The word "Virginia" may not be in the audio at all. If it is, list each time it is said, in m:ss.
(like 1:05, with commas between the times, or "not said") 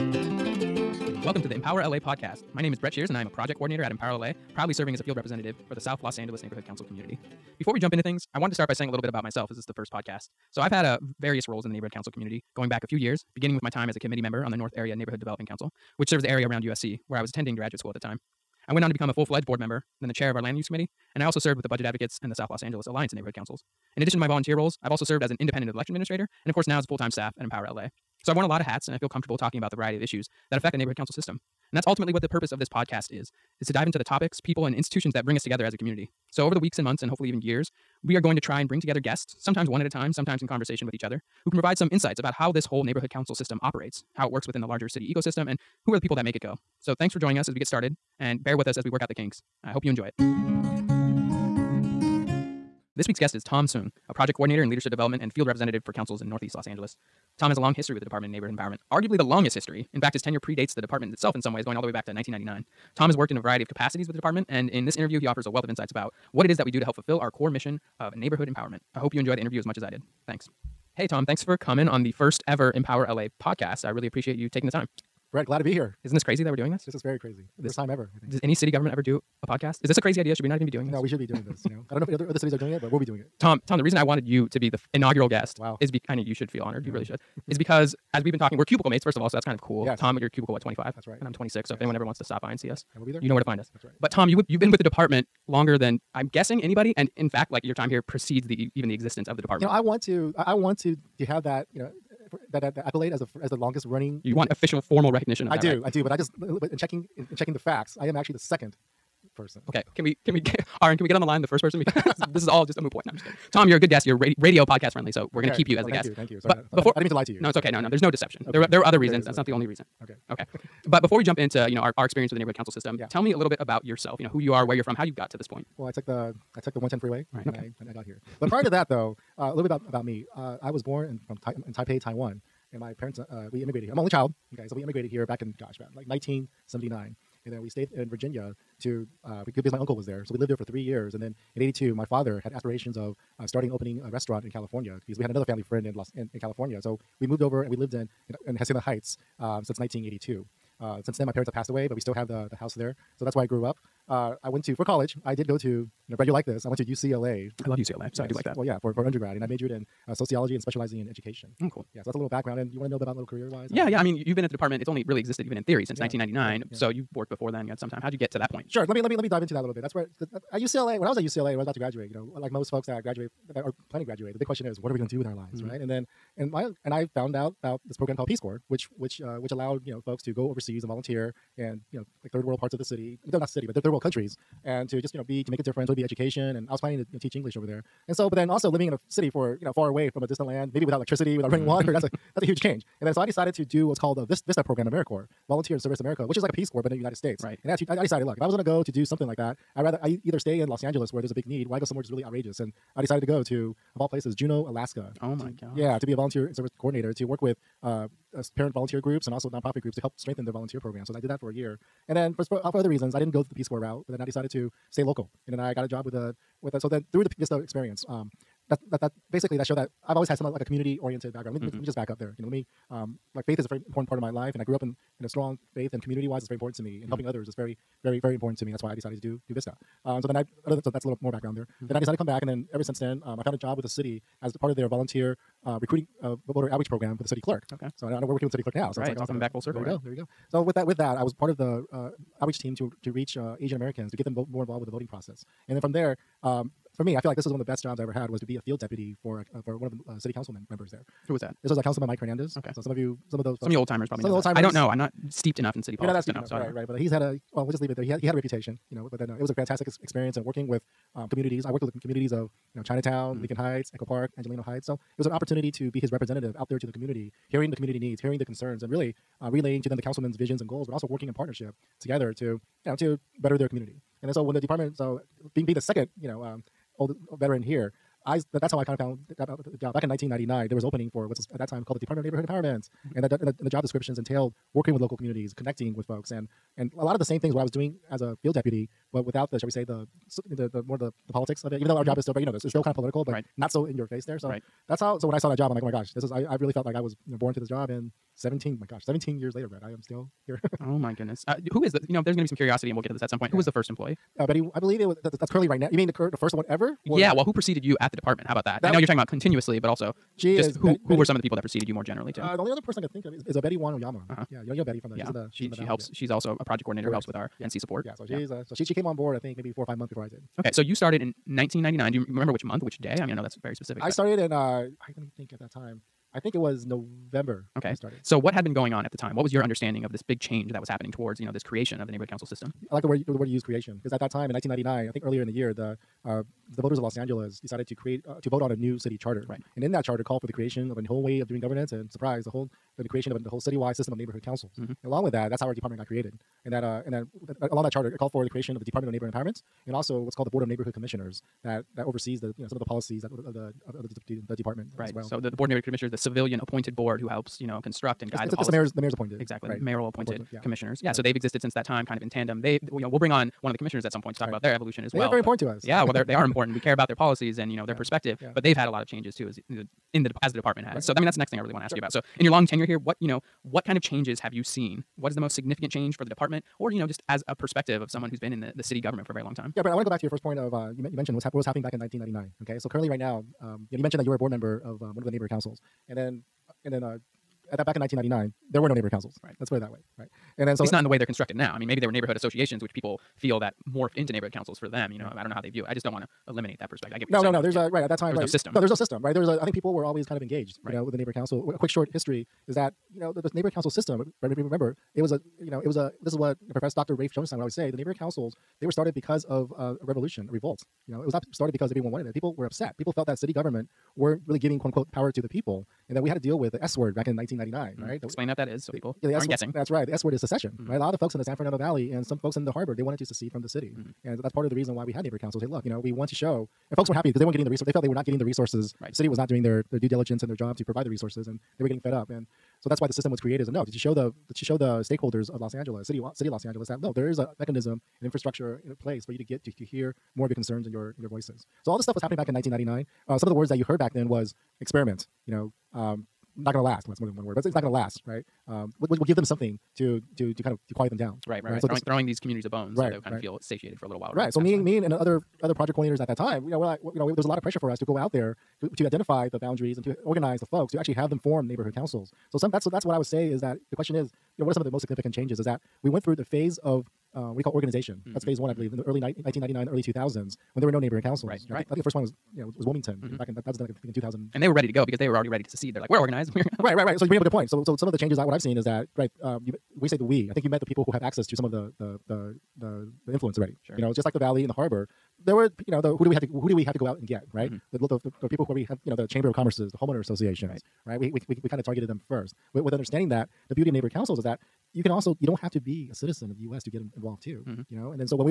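2:18.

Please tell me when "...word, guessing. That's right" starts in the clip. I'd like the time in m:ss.
6:59.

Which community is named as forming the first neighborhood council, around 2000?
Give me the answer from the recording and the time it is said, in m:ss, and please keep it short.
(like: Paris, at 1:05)
Wilmington, at 7:52.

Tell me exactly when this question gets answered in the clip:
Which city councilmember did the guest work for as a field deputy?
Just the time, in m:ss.
4:12.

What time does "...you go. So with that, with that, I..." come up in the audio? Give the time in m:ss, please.
4:00.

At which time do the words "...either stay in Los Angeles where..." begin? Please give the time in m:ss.
3:20.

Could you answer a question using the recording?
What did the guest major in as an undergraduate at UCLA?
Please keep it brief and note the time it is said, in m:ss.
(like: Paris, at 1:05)
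Sociology, at 2:40.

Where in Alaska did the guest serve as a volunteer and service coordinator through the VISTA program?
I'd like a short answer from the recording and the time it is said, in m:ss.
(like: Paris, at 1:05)
Juneau, at 3:24.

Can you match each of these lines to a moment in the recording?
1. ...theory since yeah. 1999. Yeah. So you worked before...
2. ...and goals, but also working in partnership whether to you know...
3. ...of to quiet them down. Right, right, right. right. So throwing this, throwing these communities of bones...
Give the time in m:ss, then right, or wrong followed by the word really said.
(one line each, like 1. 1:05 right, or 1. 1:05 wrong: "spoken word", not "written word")
1. 2:45 right
2. 4:30 wrong: "together", not "whether"
3. 7:30 right.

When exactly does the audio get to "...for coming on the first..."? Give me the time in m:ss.
1:11.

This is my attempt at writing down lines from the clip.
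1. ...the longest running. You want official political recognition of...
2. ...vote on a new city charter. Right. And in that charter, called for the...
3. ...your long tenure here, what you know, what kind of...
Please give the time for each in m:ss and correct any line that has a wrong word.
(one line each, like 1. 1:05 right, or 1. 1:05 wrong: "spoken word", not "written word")
1. 1:43 wrong: "formal", not "political"
2. 5:38 right
3. 6:12 right.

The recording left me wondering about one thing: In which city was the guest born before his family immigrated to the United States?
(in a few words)
Taipei.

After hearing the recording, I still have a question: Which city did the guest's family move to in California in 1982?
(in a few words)
Hacienda Heights.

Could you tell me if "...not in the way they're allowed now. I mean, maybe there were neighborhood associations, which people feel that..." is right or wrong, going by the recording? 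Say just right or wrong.
wrong.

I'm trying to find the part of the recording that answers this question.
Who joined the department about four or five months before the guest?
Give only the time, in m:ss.
5:13.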